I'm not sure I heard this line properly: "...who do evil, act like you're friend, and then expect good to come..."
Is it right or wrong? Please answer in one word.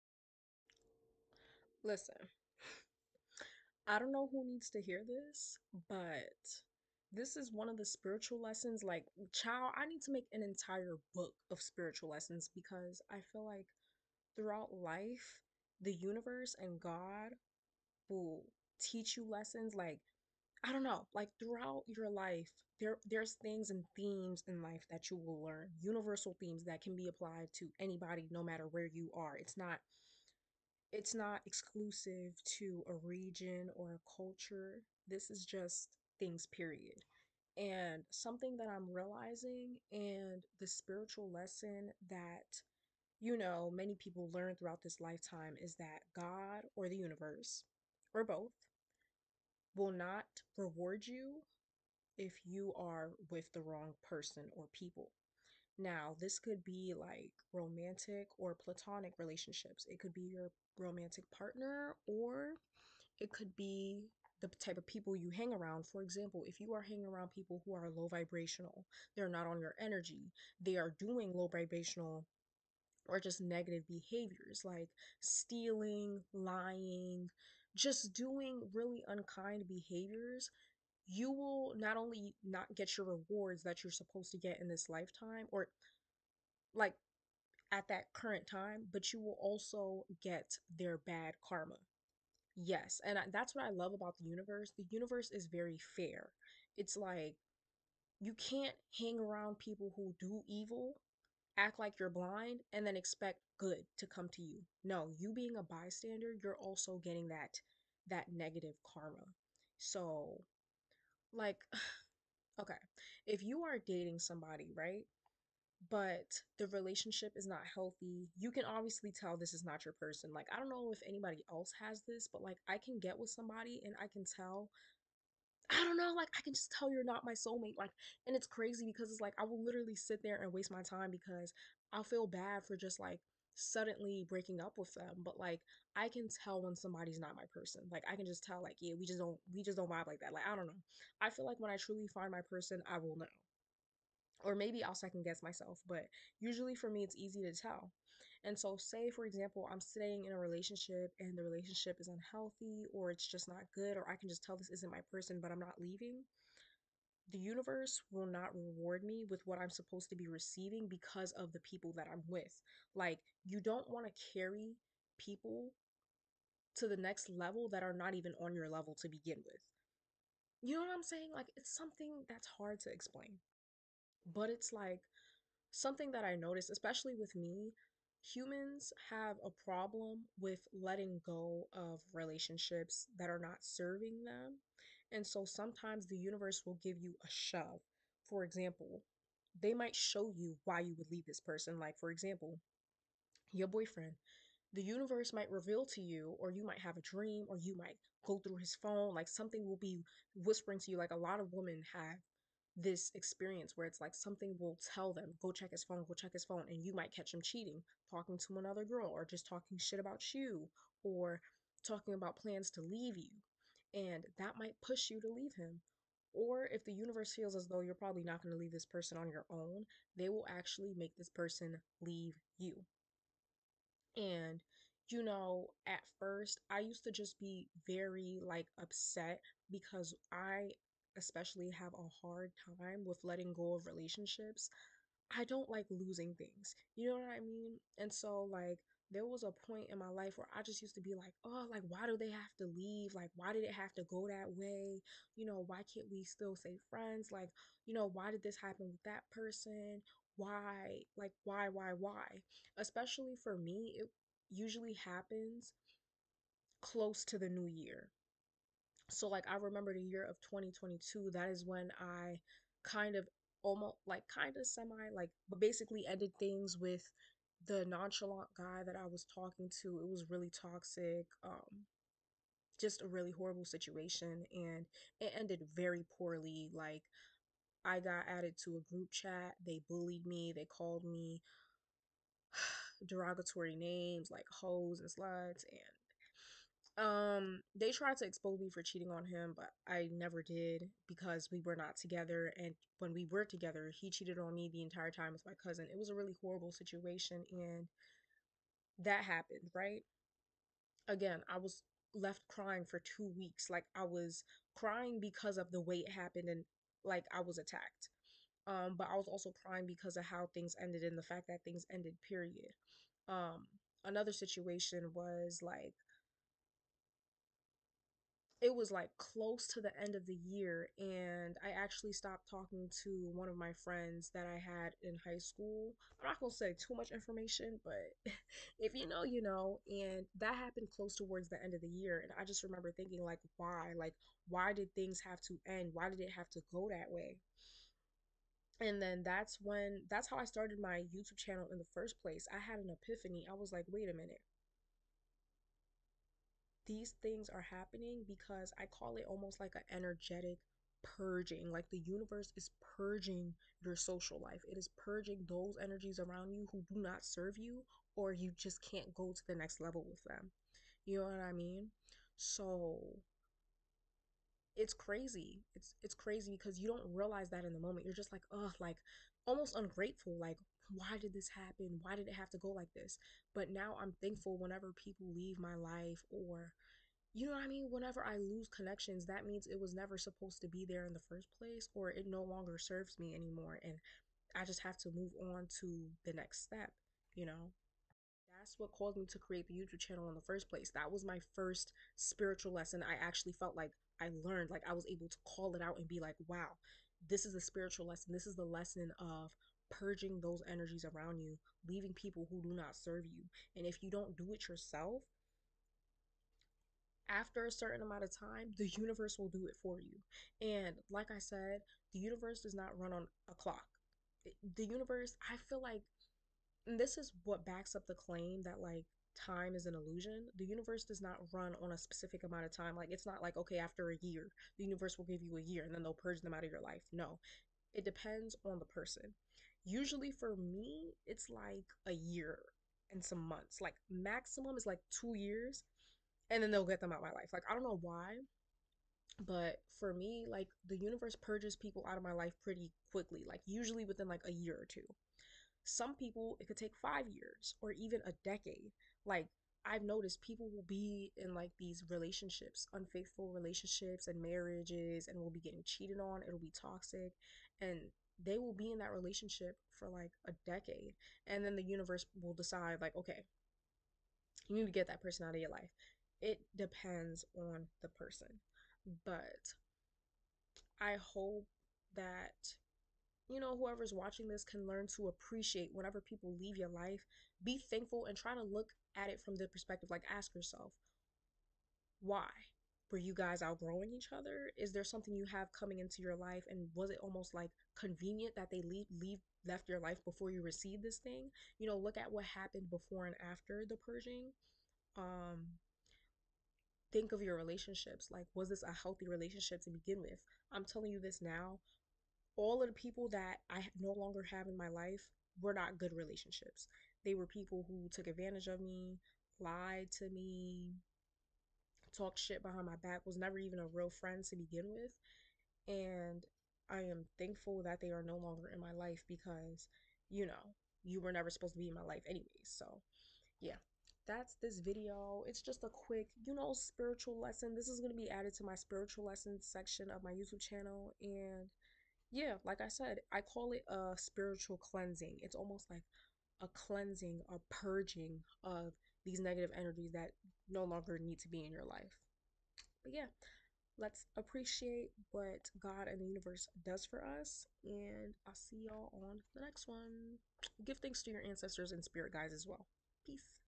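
wrong.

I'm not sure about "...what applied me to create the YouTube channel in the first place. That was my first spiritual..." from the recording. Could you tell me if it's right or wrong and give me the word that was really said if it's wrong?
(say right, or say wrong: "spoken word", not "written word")
wrong: "caused", not "applied".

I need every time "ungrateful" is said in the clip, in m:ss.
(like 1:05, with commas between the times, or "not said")
6:09.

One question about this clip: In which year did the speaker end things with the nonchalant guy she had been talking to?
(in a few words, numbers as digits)
2022.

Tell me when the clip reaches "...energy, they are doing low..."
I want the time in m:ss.
1:09.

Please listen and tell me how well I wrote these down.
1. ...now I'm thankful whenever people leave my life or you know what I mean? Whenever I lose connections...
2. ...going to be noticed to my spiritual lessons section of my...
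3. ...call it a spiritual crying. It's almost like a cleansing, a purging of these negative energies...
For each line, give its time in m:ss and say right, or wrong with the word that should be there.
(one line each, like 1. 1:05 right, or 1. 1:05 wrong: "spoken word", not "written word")
1. 6:13 right
2. 8:47 wrong: "added", not "noticed"
3. 8:53 wrong: "cleansing", not "crying".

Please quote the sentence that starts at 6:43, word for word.
And if you don't do it yourself, after a certain amount of time, the universe will do it for you.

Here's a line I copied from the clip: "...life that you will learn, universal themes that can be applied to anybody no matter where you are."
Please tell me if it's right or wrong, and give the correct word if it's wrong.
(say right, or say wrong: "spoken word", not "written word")
right.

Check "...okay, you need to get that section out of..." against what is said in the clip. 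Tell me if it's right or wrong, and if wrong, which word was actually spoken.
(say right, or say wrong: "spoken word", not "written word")
wrong: "person", not "section".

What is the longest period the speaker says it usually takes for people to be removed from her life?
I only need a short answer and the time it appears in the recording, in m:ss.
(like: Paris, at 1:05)
two years, at 7:15.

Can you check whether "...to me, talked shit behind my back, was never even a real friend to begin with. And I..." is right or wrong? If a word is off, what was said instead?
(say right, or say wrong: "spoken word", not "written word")
right.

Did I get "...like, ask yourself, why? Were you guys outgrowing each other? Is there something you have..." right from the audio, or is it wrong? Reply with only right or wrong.
right.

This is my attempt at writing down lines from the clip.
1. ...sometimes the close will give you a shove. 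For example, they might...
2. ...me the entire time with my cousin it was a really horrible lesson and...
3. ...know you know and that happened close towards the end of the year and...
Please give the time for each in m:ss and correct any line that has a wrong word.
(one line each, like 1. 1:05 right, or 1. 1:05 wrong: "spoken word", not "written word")
1. 3:05 wrong: "universe", not "close"
2. 4:54 wrong: "situation", not "lesson"
3. 5:29 right.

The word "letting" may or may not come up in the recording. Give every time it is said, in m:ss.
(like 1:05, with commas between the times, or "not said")
3:00, 3:53.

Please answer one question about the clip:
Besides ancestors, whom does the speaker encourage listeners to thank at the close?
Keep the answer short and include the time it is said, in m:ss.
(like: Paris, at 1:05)
spirit guides, at 9:12.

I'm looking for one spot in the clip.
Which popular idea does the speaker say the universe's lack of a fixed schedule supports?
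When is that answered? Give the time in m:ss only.
6:59.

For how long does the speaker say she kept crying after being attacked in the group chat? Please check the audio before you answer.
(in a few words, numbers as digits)
two weeks.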